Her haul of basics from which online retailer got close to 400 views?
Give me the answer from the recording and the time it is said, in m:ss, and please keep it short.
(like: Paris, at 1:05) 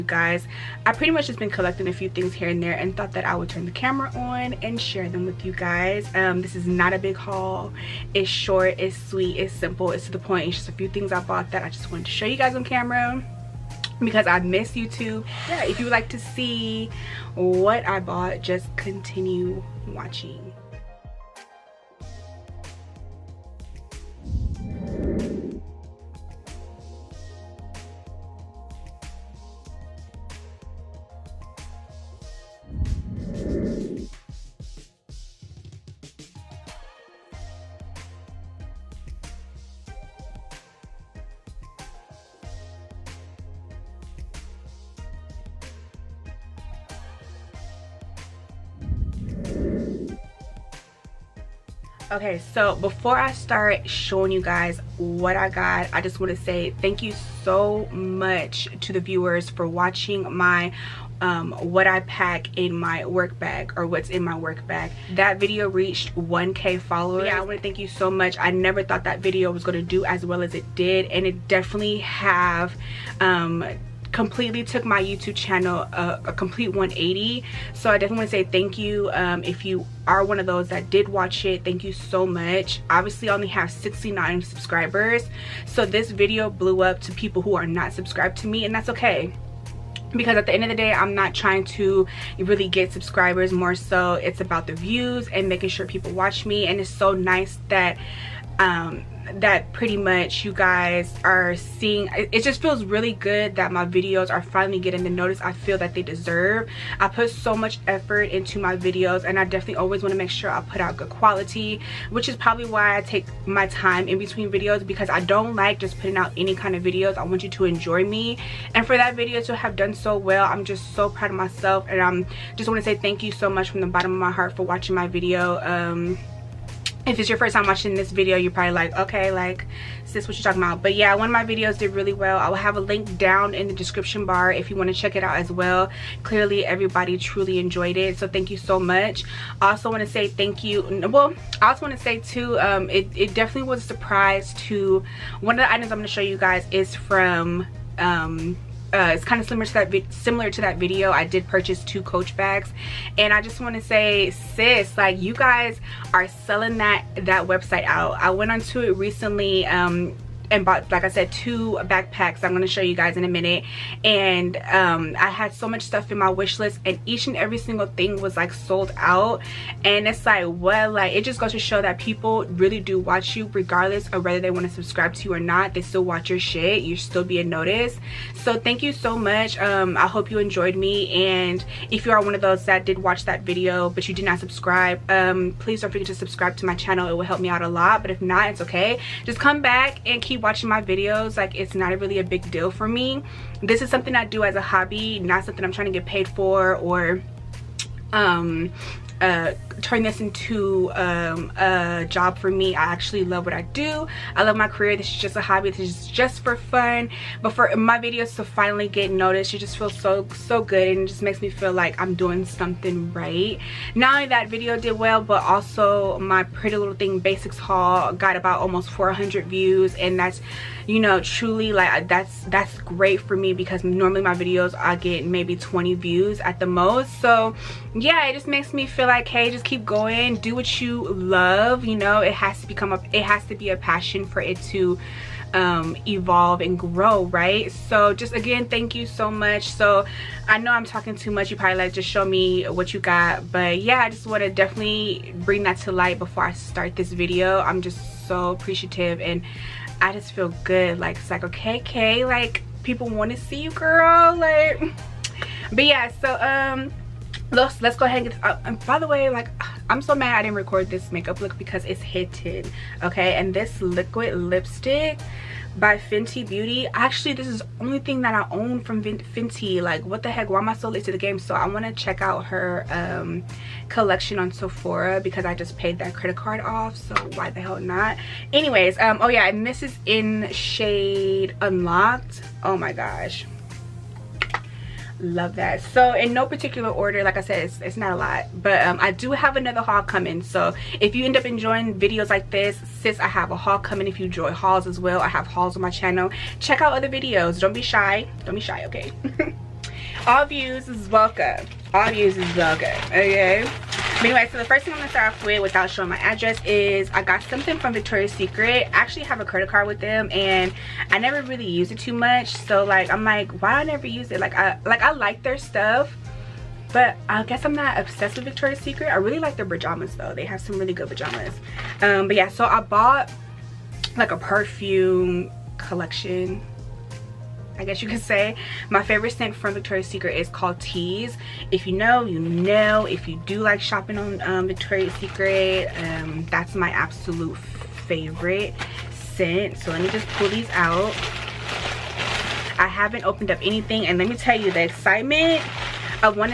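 Pretty Little Thing, at 3:36.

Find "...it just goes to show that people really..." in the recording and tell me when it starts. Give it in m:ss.
2:51.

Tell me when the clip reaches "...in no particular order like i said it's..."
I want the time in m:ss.
4:46.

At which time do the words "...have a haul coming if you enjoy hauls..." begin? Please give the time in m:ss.
4:53.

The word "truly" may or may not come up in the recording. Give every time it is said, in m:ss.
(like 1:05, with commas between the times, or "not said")
2:17, 3:41.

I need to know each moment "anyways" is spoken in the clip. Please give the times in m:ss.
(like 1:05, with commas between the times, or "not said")
4:38, 5:04.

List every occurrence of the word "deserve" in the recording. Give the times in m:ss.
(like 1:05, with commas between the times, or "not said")
1:46.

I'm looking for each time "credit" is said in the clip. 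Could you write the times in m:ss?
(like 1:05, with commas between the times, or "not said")
4:36, 5:09.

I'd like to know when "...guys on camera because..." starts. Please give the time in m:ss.
0:12.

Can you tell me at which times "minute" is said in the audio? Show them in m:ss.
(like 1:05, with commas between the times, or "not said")
2:43.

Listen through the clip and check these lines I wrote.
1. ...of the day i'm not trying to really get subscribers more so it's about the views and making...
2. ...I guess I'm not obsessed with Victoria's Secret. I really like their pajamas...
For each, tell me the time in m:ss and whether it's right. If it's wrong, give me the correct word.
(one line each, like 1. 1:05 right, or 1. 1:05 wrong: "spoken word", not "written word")
1. 1:30 right
2. 5:17 right.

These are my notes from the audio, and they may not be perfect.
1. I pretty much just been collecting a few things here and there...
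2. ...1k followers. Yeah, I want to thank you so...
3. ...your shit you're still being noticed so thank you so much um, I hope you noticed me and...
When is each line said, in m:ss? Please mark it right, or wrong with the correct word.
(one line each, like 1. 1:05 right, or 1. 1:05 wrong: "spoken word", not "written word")
1. 0:00 right
2. 1:06 right
3. 2:56 wrong: "enjoyed", not "noticed".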